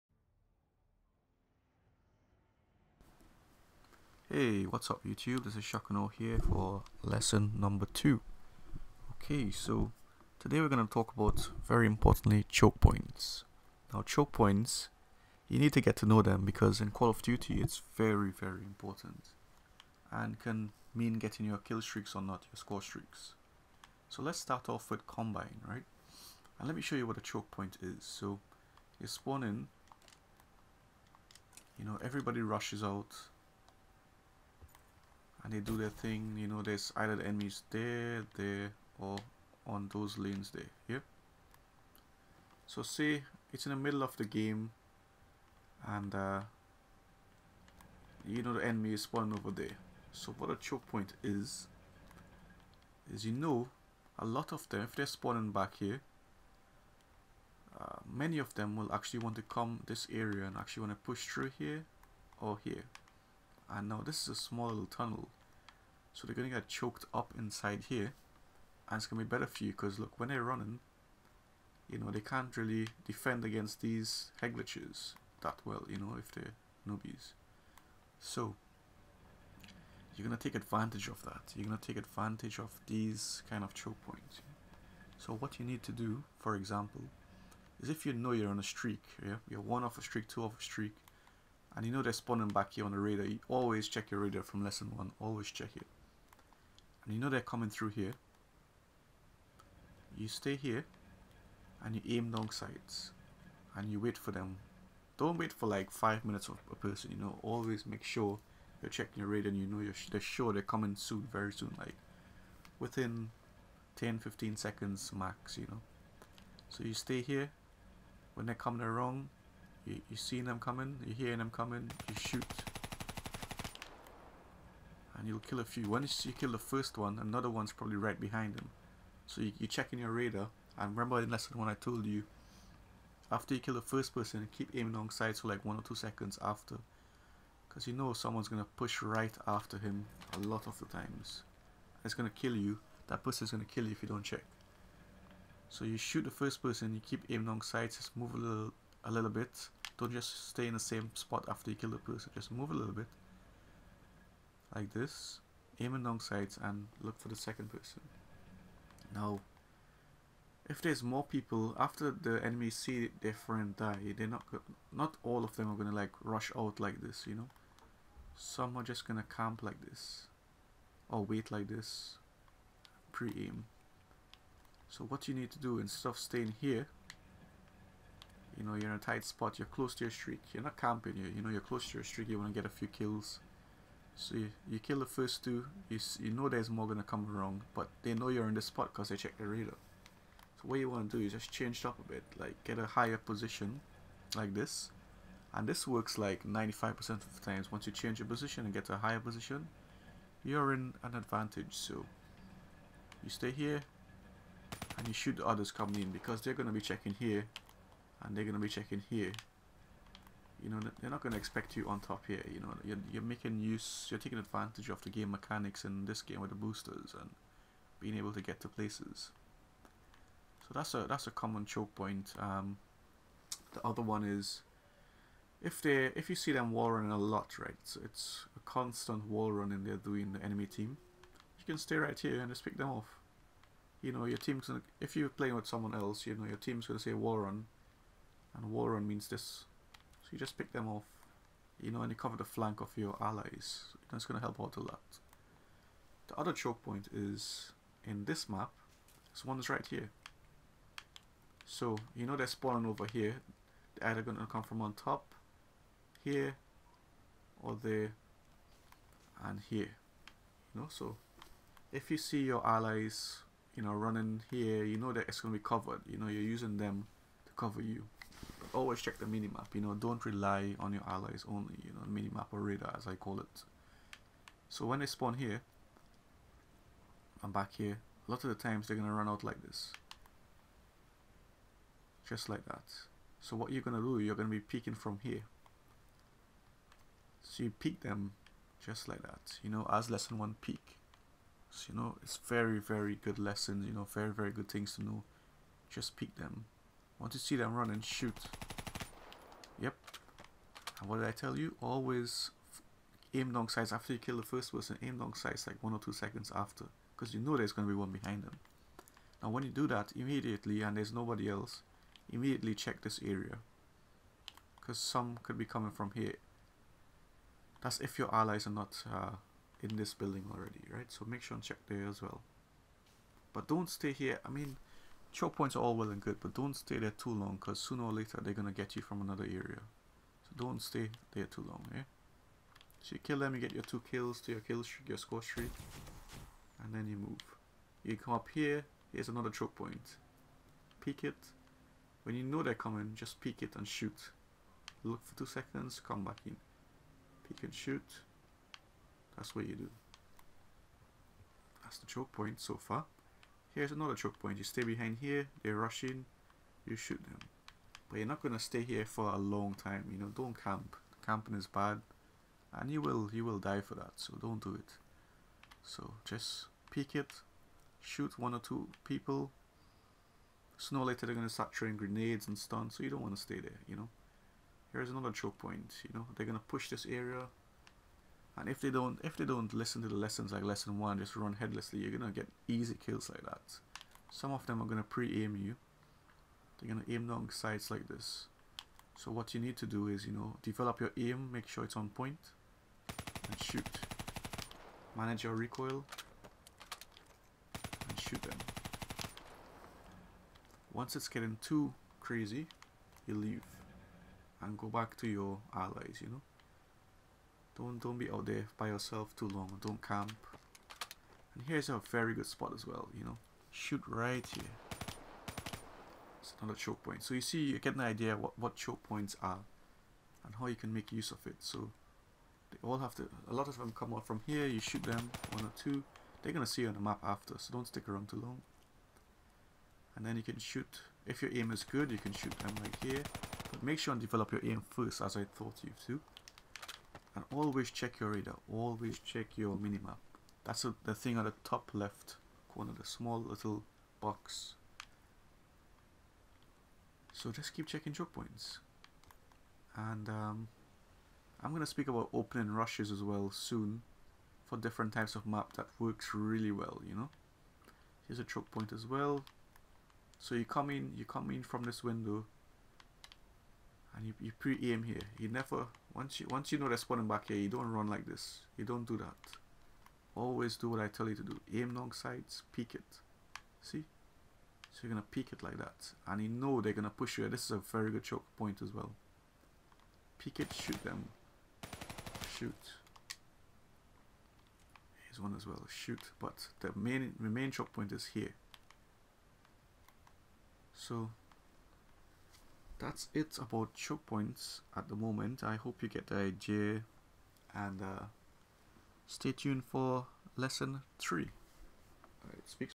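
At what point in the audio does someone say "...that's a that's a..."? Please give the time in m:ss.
3:40.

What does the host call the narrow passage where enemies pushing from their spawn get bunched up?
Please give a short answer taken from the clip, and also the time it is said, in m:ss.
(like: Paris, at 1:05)
tunnel, at 1:04.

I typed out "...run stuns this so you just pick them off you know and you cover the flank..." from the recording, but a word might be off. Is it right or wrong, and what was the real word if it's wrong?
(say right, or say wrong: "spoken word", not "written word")
wrong: "means", not "stuns".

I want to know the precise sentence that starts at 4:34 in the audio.
So when they spawn here, I'm back here, a lot of the times they're going to run out like this.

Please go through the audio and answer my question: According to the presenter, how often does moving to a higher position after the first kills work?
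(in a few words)
95%.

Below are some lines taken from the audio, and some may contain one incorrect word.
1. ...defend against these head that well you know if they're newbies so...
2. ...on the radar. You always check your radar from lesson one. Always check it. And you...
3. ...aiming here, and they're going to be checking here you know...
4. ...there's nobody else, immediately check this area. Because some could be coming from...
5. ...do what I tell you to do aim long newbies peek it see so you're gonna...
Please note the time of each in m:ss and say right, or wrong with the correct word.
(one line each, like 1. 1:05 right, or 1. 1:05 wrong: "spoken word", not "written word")
1. 1:13 right
2. 1:32 right
3. 3:26 wrong: "checking", not "aiming"
4. 5:10 right
5. 7:50 wrong: "sides", not "newbies".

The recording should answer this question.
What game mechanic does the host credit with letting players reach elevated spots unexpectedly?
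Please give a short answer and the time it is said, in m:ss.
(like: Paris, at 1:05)
boosters, at 3:36.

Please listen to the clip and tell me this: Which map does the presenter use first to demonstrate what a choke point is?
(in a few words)
Combine.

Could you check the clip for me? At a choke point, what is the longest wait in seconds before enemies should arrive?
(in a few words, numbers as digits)
10 15 seconds.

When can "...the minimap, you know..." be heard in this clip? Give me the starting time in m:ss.
4:29.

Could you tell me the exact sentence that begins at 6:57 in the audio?
So you see, you get an idea what, what choke points are and how you can make use of it.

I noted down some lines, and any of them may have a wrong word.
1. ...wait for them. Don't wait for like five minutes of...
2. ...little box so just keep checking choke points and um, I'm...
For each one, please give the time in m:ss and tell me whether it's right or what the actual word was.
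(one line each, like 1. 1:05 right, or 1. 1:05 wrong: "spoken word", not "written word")
1. 1:43 right
2. 7:23 right.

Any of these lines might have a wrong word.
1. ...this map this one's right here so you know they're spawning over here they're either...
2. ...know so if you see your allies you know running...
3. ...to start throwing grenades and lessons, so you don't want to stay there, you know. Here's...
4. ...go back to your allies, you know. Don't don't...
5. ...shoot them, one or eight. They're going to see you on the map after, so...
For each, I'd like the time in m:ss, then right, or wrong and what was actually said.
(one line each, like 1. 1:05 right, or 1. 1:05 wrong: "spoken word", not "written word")
1. 4:08 right
2. 4:20 right
3. 6:11 wrong: "stuns", not "lessons"
4. 6:44 right
5. 7:04 wrong: "two", not "eight".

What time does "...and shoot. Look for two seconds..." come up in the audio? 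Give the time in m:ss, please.
5:43.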